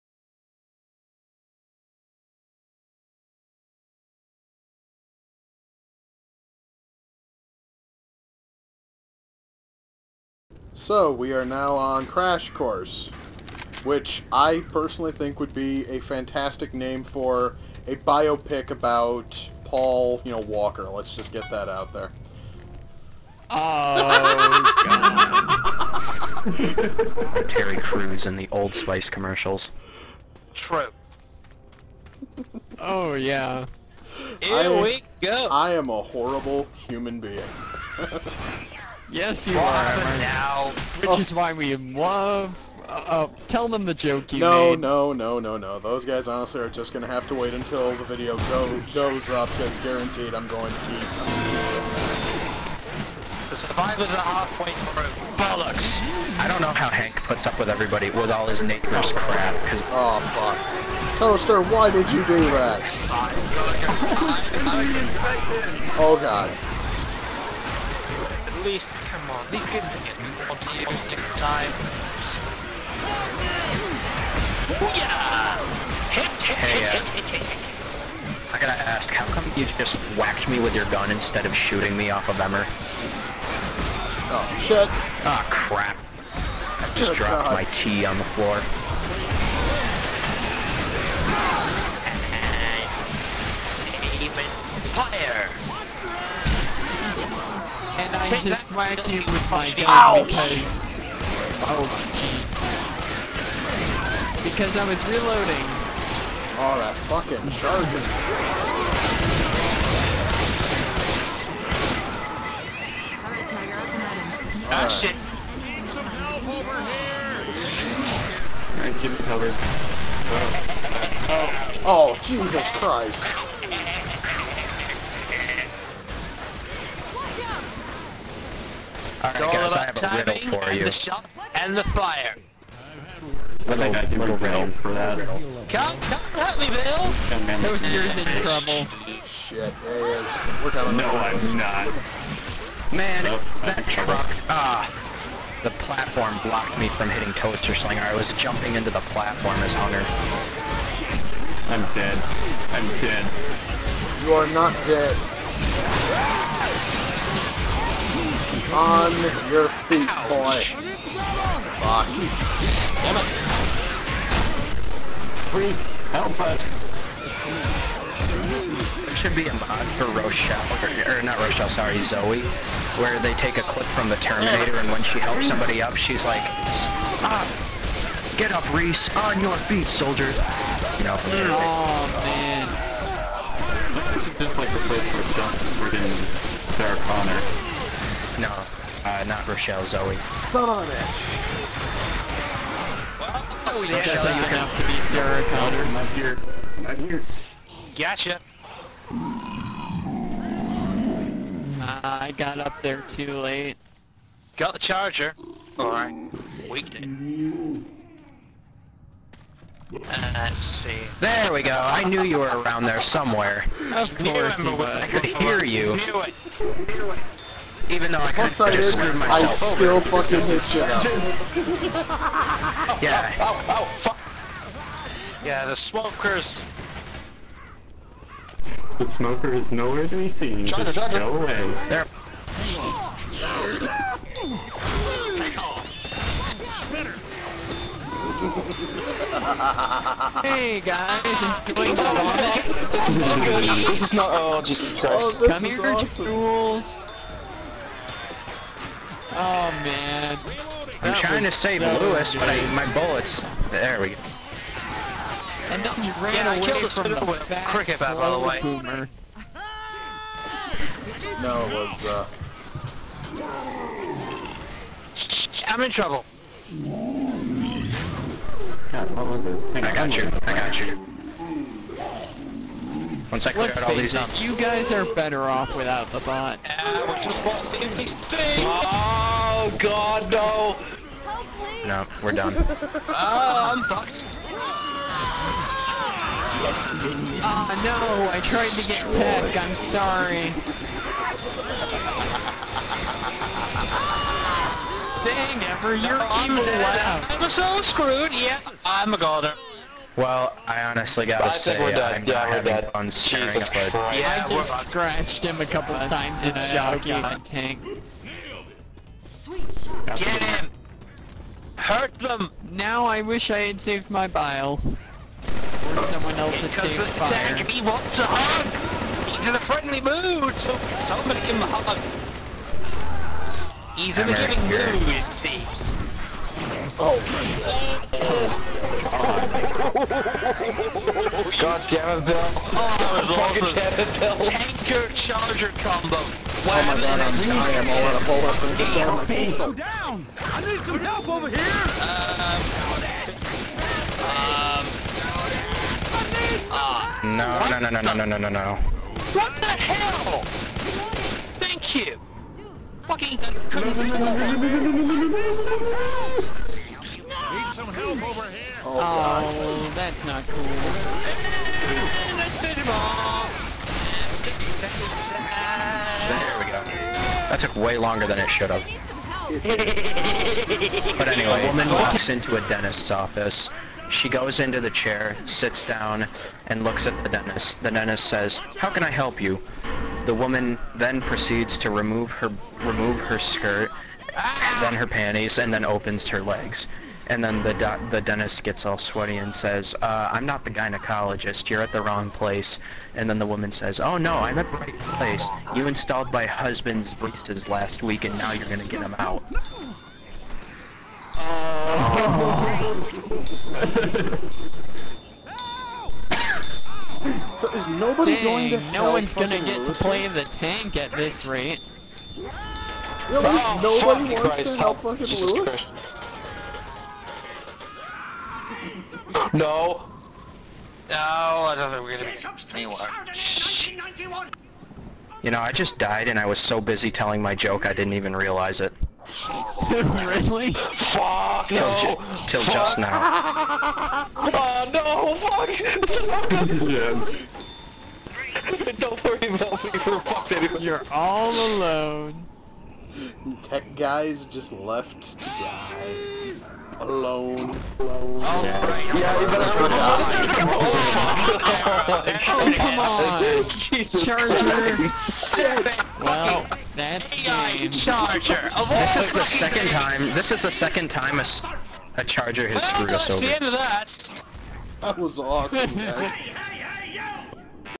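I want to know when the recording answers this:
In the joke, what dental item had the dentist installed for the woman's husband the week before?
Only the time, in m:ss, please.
6:37.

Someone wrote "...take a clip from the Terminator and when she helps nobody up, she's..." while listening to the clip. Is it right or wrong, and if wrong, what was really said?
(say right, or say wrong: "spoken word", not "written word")
wrong: "somebody", not "nobody".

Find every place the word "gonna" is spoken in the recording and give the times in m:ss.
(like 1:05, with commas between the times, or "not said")
0:46, 6:38, 6:49, 7:02.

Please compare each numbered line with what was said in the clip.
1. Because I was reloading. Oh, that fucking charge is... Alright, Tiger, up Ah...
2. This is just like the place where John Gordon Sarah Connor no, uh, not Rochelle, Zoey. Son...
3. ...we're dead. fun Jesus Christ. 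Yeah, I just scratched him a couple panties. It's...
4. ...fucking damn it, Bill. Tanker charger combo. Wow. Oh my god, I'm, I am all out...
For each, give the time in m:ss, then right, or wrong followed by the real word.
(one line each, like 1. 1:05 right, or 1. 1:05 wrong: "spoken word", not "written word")
1. 1:44 right
2. 3:04 right
3. 5:02 wrong: "times", not "panties"
4. 5:33 right.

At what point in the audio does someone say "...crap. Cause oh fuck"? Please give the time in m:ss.
0:59.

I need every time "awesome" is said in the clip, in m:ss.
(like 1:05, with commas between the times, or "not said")
4:05, 7:45.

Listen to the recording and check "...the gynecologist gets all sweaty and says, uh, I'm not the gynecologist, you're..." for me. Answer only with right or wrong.
wrong.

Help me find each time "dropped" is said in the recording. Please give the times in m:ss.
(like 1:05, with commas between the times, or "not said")
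1:27.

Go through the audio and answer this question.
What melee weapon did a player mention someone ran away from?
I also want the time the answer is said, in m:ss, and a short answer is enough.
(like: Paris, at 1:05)
Cricket bat, at 4:17.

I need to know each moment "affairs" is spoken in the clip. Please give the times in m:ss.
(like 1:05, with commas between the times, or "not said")
not said.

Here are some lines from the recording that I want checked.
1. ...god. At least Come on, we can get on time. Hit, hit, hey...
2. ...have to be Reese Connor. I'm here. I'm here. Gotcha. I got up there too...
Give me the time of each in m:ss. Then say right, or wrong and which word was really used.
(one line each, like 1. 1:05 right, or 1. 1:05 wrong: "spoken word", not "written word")
1. 1:06 right
2. 3:14 wrong: "Sarah", not "Reese".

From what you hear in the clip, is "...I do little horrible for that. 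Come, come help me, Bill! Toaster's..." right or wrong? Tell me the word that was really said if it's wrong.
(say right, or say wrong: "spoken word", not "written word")
wrong: "riddle", not "horrible".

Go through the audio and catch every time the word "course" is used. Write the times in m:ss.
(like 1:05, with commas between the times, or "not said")
0:12, 3:34.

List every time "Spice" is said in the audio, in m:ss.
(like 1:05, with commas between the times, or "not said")
0:28.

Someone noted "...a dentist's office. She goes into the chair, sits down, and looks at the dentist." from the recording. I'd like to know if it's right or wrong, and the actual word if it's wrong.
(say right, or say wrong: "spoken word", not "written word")
right.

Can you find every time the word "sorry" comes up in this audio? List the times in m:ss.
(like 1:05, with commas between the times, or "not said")
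2:51, 4:49.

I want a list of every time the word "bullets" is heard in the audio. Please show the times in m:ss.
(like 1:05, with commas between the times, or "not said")
4:12, 5:38.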